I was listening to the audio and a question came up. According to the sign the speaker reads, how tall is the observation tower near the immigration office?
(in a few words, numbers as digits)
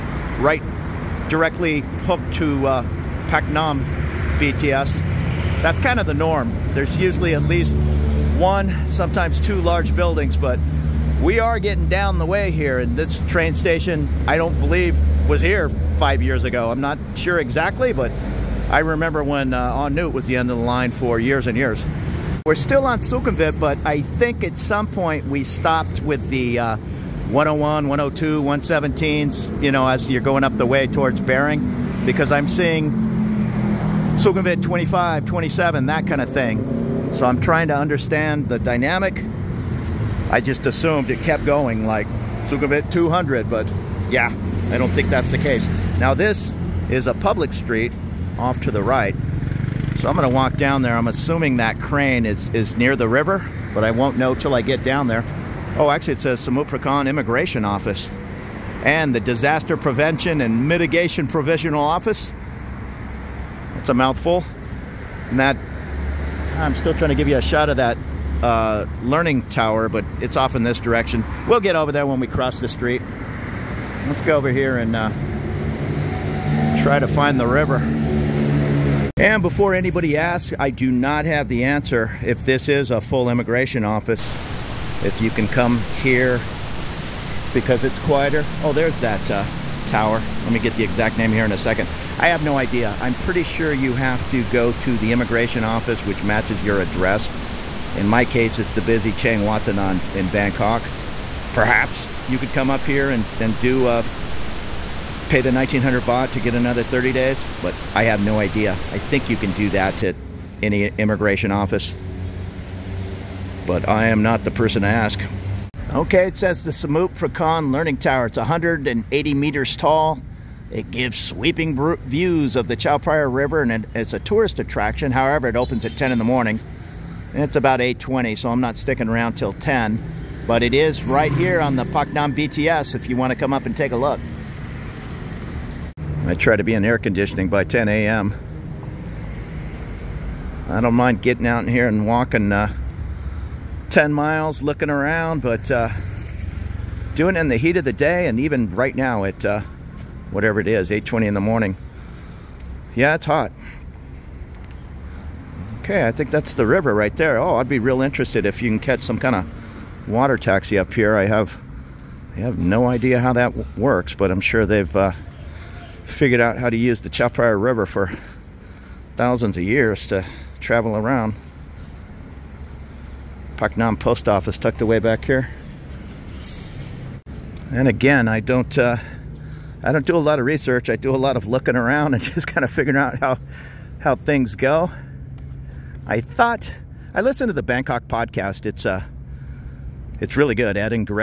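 180 meters.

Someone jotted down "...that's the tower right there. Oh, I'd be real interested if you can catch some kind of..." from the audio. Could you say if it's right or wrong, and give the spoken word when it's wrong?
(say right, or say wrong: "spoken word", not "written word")
wrong: "river", not "tower".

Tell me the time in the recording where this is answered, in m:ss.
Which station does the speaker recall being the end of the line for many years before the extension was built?
0:19.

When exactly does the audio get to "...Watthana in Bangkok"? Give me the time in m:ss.
1:39.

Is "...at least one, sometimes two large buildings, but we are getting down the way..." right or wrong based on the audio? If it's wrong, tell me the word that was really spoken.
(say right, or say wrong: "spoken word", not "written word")
right.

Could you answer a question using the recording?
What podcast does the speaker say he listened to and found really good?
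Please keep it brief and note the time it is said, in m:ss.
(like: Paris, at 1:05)
Bangkok podcast, at 3:07.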